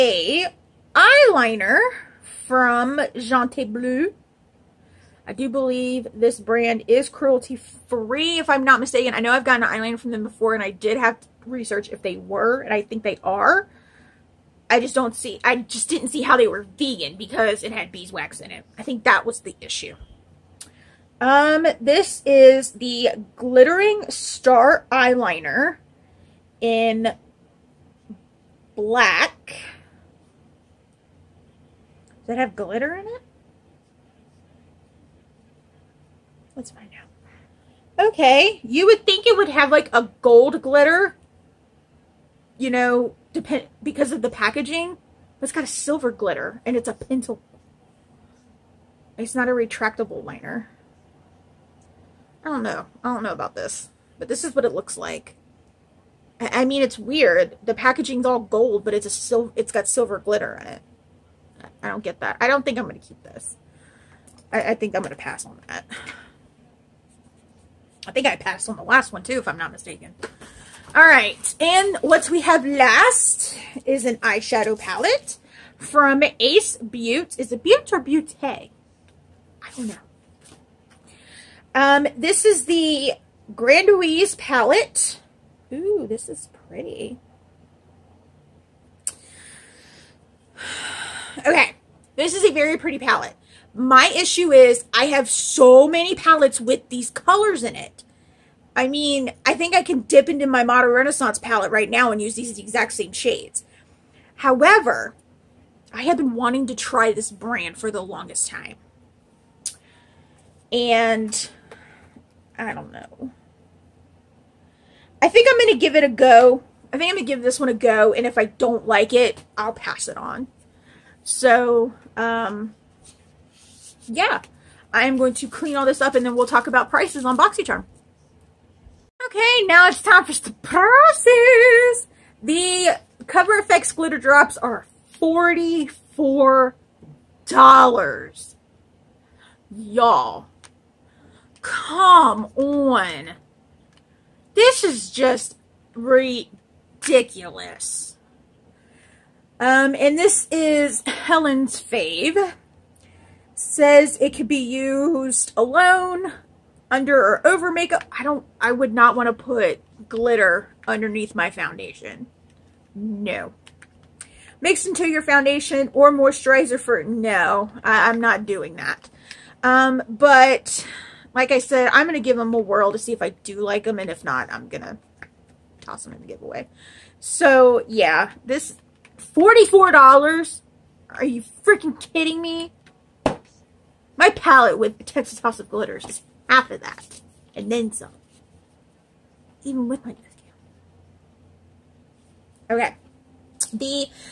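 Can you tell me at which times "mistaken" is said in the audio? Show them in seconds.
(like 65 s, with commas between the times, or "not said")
8 s, 69 s.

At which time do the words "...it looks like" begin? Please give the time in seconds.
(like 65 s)
54 s.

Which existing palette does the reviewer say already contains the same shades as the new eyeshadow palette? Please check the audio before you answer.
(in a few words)
Modern Renaissance.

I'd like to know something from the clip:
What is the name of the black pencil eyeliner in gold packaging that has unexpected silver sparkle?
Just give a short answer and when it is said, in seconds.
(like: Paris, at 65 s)
Glittering Star Eyeliner, at 23 s.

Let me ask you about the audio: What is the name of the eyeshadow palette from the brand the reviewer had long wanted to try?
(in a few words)
Grandeur.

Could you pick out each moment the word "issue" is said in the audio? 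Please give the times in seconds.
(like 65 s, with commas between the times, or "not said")
19 s, 94 s.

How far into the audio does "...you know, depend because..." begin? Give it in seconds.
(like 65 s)
42 s.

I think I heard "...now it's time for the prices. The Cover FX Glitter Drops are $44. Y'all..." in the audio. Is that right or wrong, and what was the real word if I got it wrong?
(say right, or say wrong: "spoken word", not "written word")
right.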